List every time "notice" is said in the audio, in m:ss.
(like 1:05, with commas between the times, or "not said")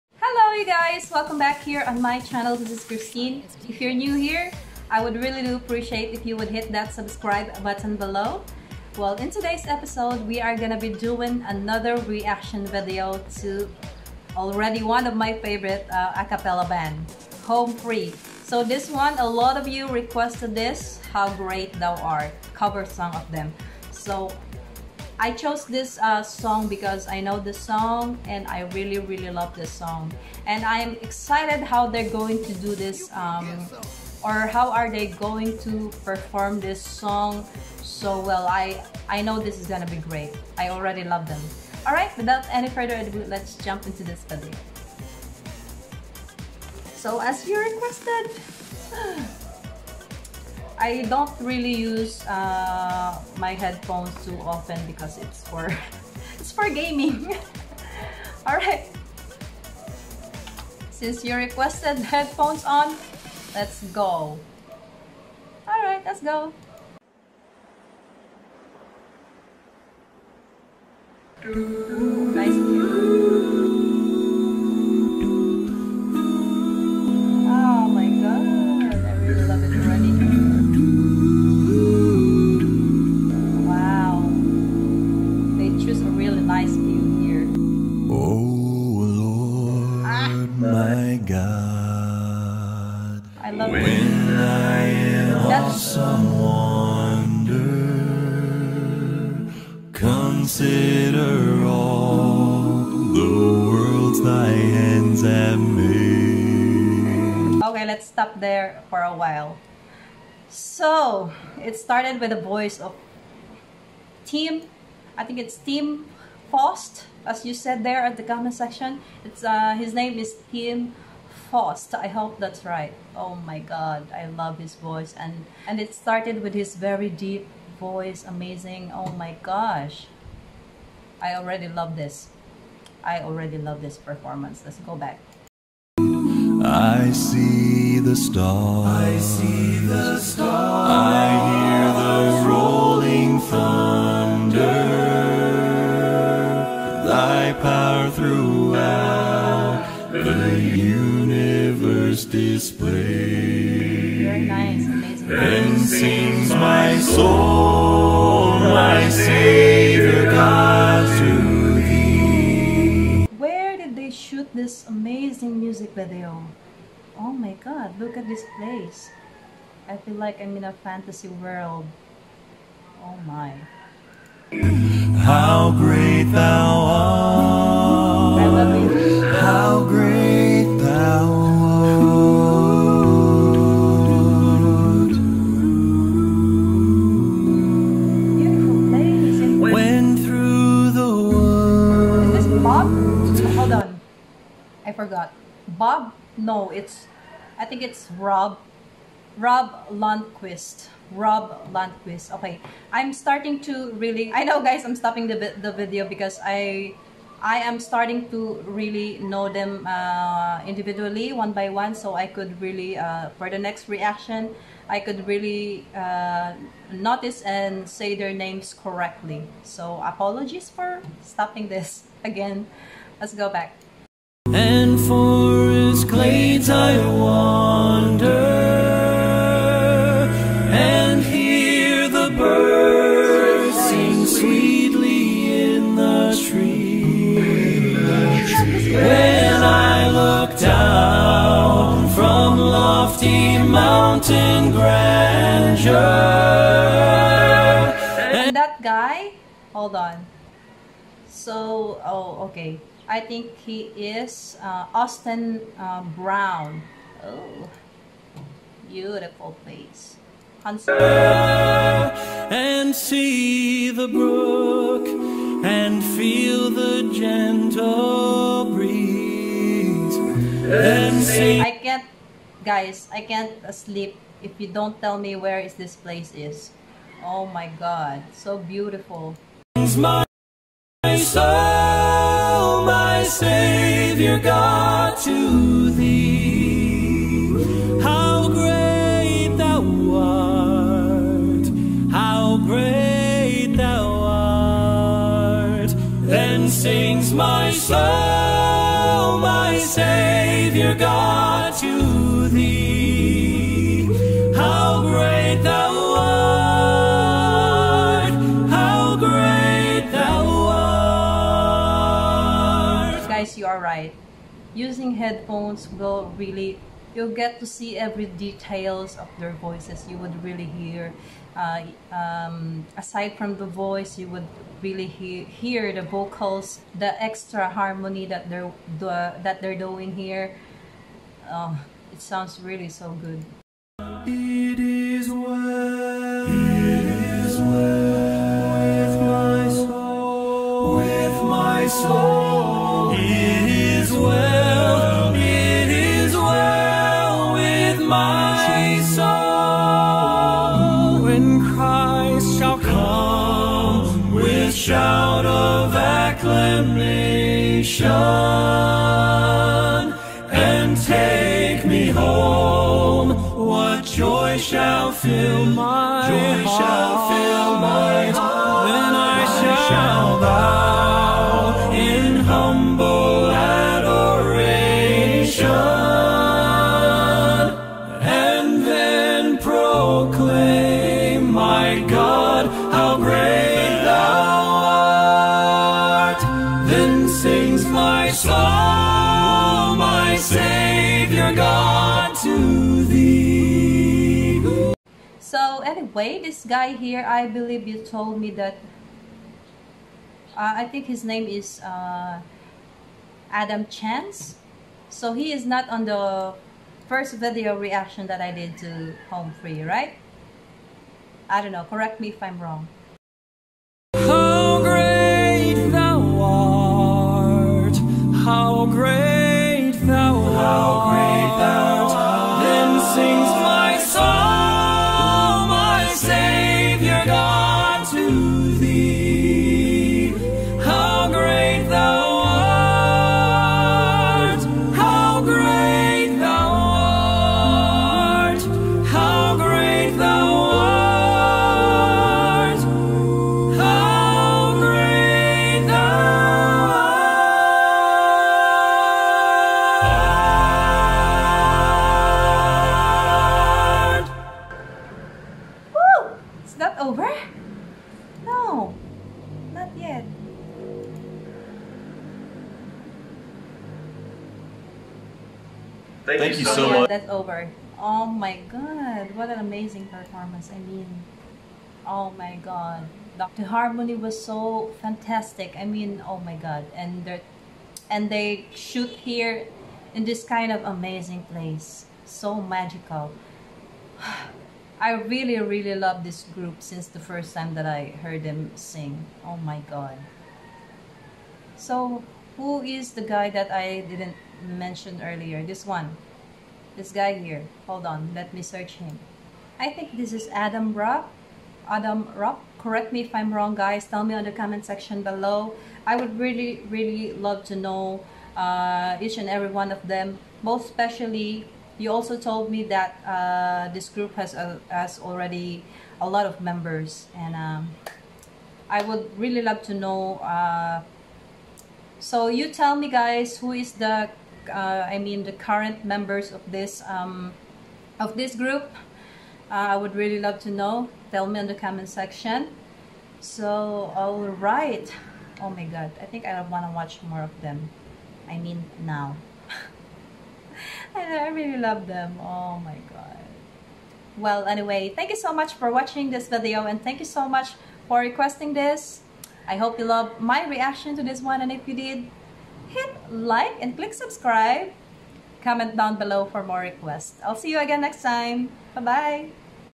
3:36.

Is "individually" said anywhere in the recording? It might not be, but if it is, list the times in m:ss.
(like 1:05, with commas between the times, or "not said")
3:30.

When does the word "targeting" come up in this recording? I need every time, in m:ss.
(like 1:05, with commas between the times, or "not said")
not said.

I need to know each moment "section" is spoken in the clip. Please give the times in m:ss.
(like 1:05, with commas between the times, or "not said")
1:58, 8:24, 8:52.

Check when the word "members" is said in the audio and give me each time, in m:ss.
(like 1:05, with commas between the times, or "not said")
8:36, 8:46.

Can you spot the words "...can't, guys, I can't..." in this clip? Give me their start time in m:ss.
4:31.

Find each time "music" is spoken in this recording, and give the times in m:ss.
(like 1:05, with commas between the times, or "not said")
2:45.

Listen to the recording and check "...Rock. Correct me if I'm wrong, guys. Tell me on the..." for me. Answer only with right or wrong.
right.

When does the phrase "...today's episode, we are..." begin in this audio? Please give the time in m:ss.
0:09.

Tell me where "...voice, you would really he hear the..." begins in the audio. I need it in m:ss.
5:23.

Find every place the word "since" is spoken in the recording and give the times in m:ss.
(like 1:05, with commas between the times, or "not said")
1:00, 8:06.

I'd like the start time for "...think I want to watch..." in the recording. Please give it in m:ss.
8:56.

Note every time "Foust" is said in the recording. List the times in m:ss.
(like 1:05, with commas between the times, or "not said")
1:56, 2:01.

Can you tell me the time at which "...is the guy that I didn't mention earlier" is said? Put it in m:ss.
8:12.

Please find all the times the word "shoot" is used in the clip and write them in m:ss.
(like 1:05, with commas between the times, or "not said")
2:44, 7:58.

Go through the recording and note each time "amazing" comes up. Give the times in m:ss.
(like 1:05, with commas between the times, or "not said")
2:08, 2:44, 7:49, 8:00.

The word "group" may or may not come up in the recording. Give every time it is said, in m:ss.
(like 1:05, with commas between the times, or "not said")
8:06, 8:34, 8:48.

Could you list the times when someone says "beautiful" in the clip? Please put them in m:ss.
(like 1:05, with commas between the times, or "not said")
4:18, 4:38.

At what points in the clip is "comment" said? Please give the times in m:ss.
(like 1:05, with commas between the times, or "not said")
1:58, 8:24, 8:51, 9:15.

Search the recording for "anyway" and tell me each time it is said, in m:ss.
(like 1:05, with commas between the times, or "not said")
6:35, 9:04.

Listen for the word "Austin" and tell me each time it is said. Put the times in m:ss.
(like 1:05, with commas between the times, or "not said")
4:14.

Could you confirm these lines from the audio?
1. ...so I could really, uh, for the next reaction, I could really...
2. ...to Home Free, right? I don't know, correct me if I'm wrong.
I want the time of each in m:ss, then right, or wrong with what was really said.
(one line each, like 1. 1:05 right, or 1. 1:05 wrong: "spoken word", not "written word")
1. 3:31 right
2. 6:48 right.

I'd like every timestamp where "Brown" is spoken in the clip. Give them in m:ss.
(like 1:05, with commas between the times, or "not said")
4:16.